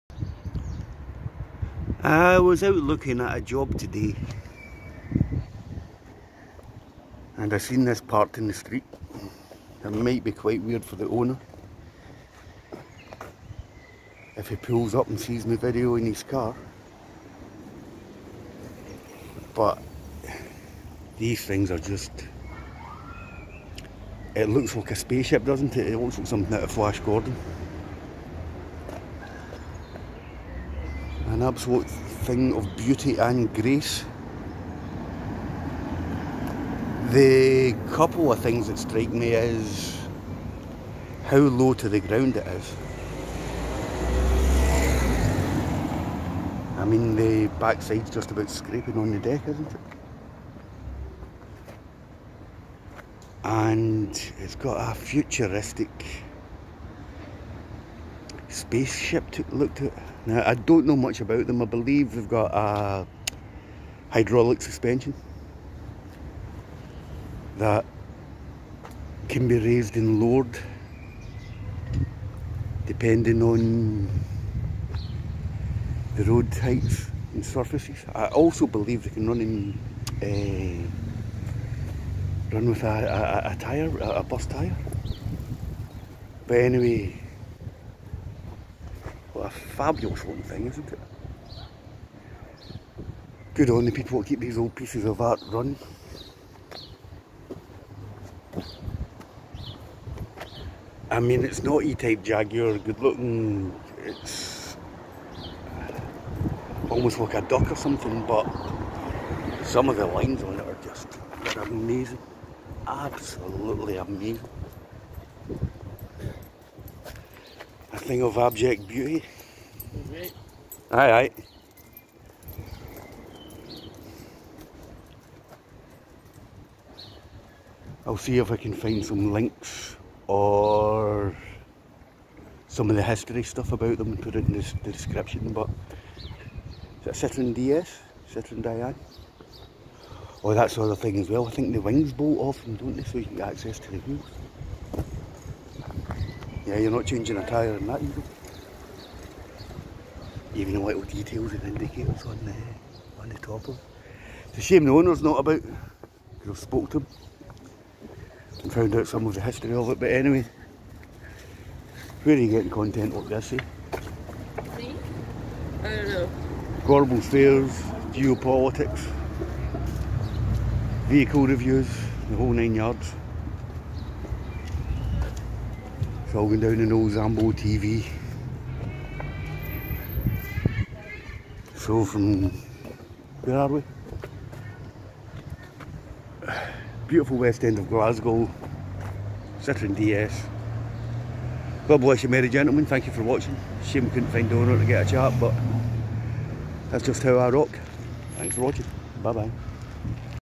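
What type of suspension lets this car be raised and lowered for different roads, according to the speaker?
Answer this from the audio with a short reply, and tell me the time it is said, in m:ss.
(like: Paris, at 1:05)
Hydraulic, at 1:04.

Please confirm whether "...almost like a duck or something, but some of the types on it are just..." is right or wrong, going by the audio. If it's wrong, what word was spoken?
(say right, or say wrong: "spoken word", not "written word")
wrong: "lines", not "types".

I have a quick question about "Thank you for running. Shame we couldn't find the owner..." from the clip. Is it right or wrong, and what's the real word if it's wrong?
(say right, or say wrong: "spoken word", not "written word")
wrong: "watching", not "running".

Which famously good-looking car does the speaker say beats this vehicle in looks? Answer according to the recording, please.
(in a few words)
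E-type Jaguar.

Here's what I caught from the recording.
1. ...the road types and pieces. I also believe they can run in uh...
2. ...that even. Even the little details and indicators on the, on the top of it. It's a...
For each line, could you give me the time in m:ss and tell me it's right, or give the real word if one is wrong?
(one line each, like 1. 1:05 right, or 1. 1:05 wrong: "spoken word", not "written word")
1. 1:16 wrong: "surfaces", not "pieces"
2. 2:27 right.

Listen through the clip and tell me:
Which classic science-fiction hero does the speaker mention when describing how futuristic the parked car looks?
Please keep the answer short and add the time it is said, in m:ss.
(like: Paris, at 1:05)
Flash Gordon, at 0:26.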